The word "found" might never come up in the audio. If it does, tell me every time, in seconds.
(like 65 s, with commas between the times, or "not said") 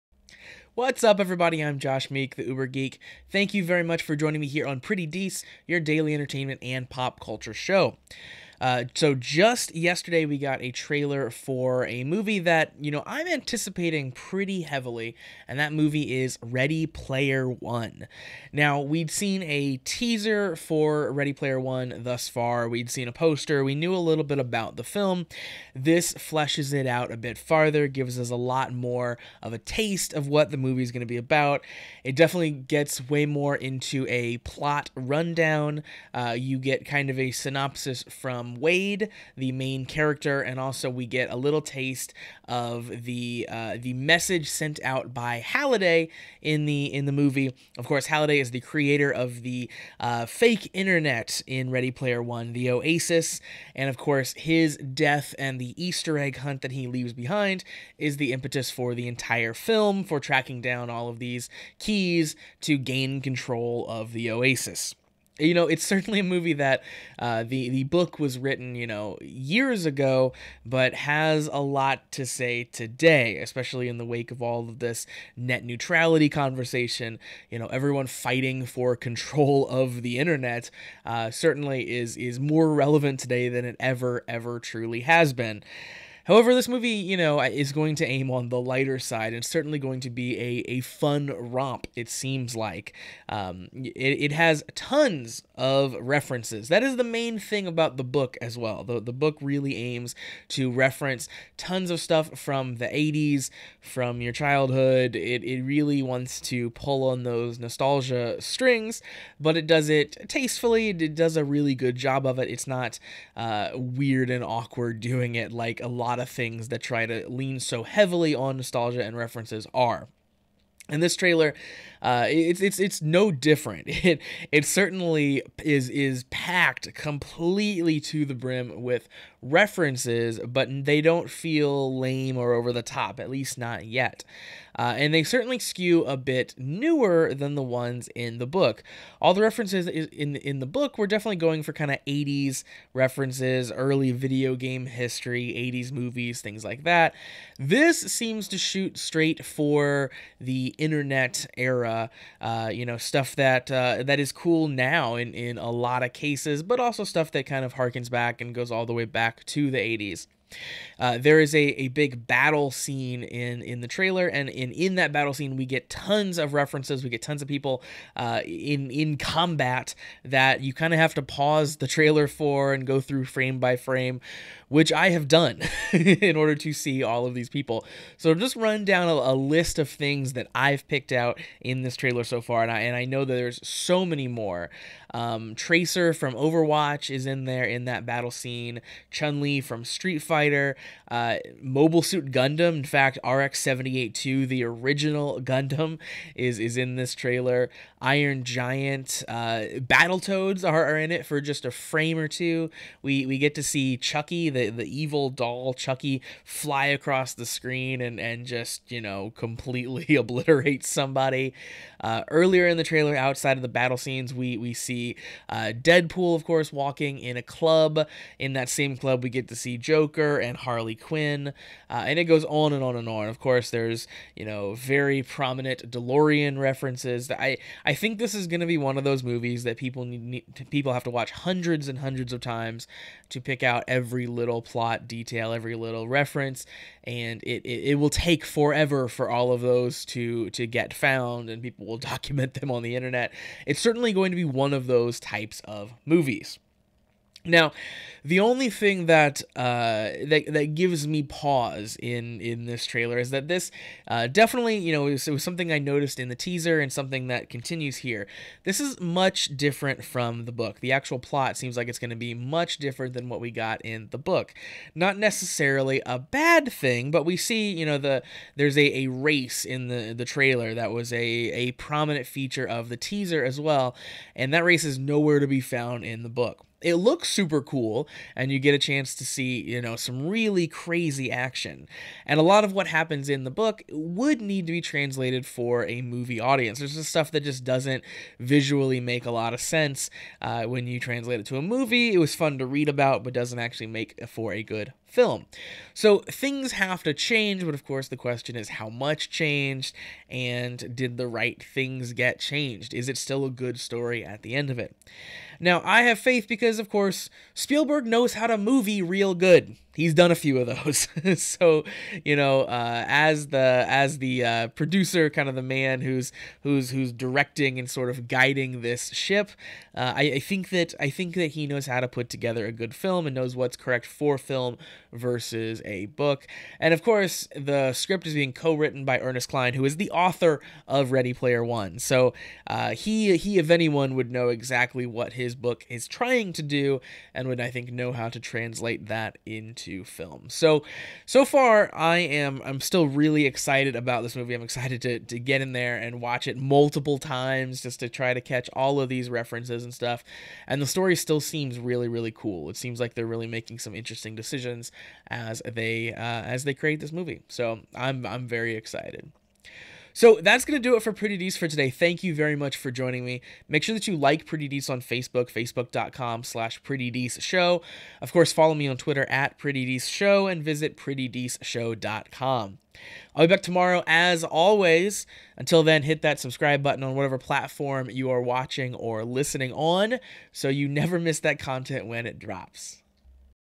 240 s, 275 s.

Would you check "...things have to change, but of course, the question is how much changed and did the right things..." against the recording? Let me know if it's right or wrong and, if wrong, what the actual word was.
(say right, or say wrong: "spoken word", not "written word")
right.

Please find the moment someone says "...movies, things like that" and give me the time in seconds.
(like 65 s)
145 s.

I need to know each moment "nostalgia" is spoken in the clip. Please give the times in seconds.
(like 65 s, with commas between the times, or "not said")
107 s, 118 s.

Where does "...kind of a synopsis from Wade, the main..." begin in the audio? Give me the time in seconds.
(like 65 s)
36 s.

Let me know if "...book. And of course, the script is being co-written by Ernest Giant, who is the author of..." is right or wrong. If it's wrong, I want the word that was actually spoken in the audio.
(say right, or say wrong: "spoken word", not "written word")
wrong: "Cline", not "Giant".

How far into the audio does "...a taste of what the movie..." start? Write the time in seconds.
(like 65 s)
29 s.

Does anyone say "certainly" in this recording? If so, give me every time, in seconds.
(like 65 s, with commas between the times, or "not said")
65 s, 81 s, 89 s, 124 s, 135 s, 243 s.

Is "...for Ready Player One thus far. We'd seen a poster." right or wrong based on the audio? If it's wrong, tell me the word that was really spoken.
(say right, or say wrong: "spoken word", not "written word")
right.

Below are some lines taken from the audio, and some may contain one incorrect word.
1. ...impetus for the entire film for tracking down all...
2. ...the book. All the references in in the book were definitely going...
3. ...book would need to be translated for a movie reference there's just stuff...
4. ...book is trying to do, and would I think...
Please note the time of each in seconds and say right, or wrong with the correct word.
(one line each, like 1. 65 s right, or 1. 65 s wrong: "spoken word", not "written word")
1. 58 s right
2. 138 s right
3. 283 s wrong: "audience", not "reference"
4. 335 s right.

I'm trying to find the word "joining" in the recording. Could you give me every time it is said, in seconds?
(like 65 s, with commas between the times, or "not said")
4 s, 362 s.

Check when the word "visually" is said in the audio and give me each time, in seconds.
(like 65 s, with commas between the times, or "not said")
288 s.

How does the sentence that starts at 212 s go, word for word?
Uh, earlier in the trailer, outside of the battle scenes, we we see uh, Deadpool, of course, walking in a club.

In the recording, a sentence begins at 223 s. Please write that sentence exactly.
Of course, there's you know very prominent DeLorean references.